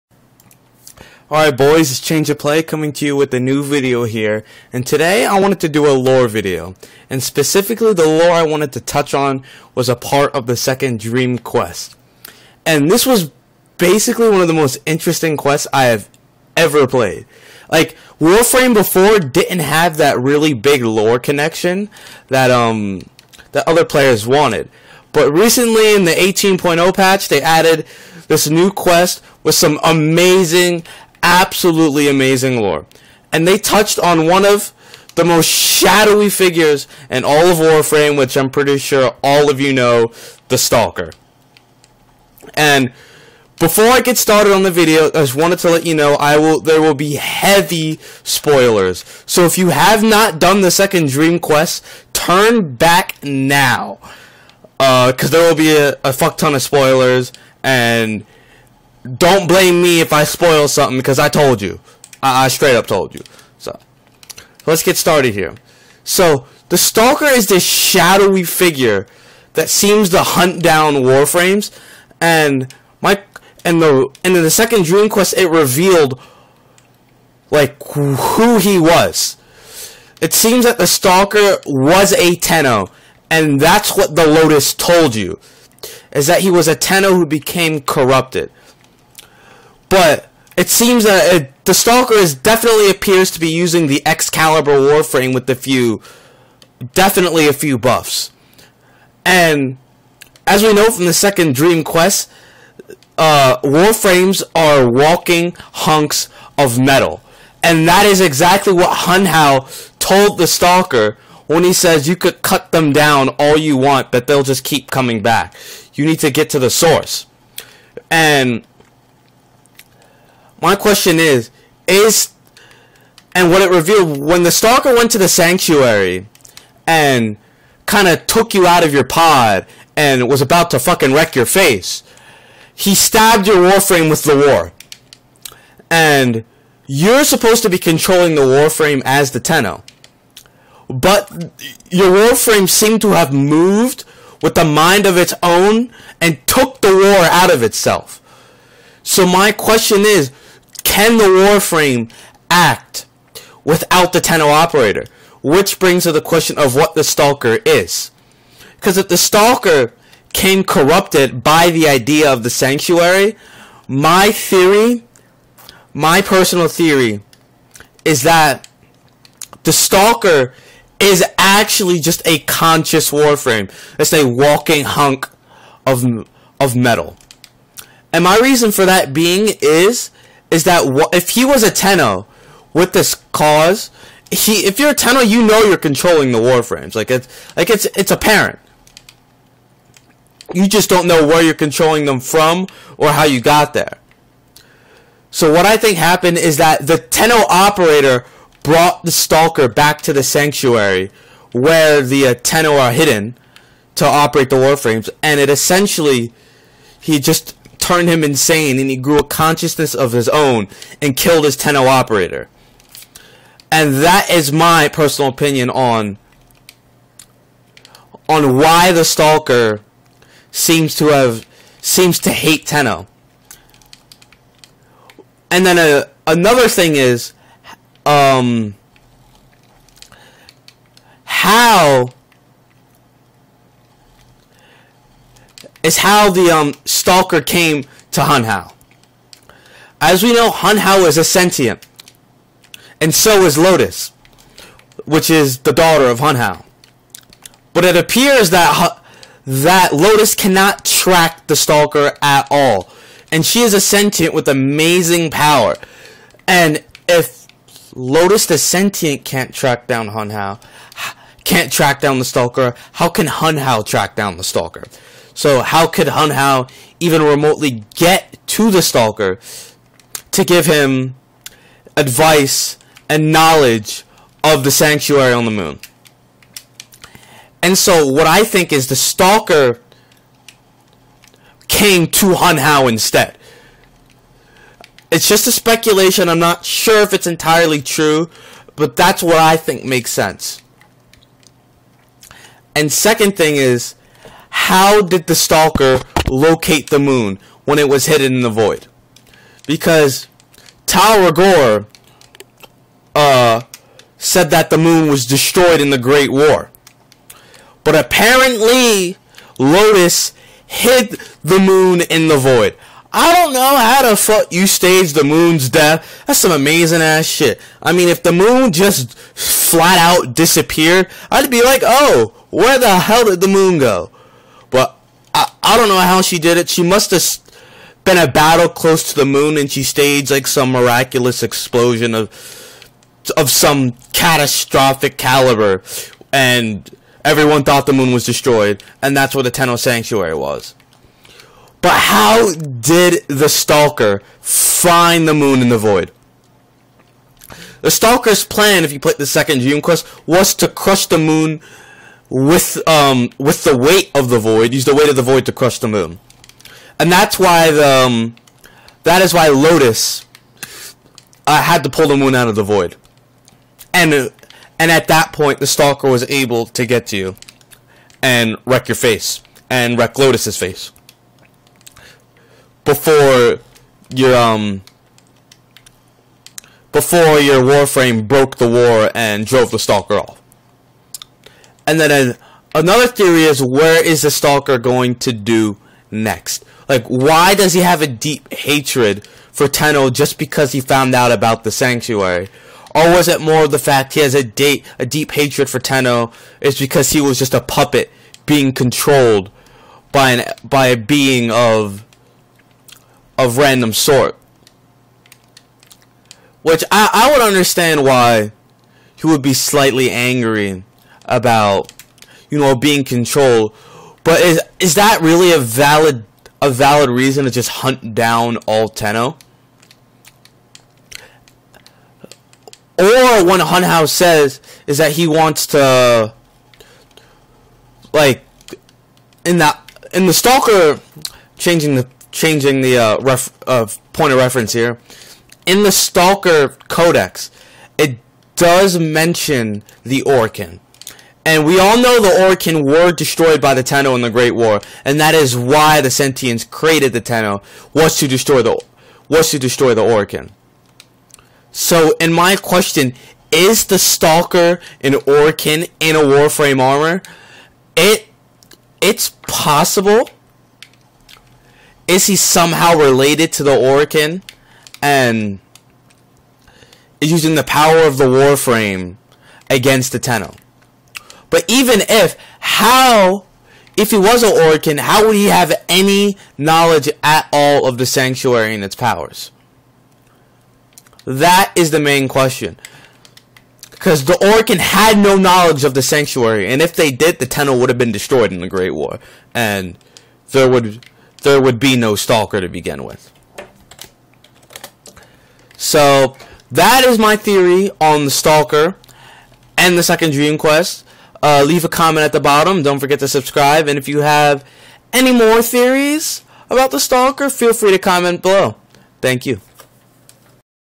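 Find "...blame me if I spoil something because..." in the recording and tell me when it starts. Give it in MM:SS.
00:59.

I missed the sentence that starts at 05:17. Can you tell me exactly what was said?
I mean, if the moon just flat out disappeared, I'd be like, oh, where the hell did the moon go?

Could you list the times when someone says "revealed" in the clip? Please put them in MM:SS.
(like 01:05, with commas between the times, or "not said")
01:15, 02:03.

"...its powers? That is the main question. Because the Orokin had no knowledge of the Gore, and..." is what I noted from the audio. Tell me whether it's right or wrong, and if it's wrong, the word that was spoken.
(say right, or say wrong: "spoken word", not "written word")
wrong: "Sanctuary", not "Gore".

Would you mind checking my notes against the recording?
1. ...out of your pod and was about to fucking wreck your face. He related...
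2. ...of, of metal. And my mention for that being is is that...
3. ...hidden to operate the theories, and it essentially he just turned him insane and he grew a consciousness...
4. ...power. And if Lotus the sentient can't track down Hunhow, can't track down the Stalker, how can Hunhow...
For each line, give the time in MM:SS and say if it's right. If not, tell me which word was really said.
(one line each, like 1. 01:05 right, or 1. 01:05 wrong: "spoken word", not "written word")
1. 02:08 wrong: "stabbed", not "related"
2. 02:55 wrong: "reason", not "mention"
3. 03:22 wrong: "warframes", not "theories"
4. 04:15 right.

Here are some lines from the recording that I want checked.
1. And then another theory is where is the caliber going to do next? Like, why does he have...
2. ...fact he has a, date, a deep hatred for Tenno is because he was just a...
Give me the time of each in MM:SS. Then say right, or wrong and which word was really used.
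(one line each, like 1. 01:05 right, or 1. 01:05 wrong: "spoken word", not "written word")
1. 06:21 wrong: "stalker", not "caliber"
2. 06:33 right.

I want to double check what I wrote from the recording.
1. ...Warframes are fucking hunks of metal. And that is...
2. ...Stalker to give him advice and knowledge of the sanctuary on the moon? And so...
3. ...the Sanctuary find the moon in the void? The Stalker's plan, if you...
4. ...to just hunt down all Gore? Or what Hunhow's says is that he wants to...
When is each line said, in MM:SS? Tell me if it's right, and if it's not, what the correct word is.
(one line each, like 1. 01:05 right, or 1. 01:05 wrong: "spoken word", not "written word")
1. 01:43 wrong: "walking", not "fucking"
2. 04:28 right
3. 05:43 wrong: "Stalker", not "Sanctuary"
4. 06:57 wrong: "Tenno", not "Gore".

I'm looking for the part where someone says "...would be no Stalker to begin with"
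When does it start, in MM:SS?
08:11.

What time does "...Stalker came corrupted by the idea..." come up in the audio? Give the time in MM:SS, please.
02:39.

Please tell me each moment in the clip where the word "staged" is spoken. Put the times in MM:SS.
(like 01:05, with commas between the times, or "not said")
05:14, 05:29.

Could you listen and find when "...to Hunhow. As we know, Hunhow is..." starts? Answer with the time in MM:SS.
03:58.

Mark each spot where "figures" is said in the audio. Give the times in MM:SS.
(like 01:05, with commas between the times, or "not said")
00:36, 01:08.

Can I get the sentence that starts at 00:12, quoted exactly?
And this was basically one of the most interesting quests I have ever played.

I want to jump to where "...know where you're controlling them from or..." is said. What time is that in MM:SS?
03:11.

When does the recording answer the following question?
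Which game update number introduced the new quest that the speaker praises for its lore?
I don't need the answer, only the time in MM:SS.
00:26.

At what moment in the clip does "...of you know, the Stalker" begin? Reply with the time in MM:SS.
00:39.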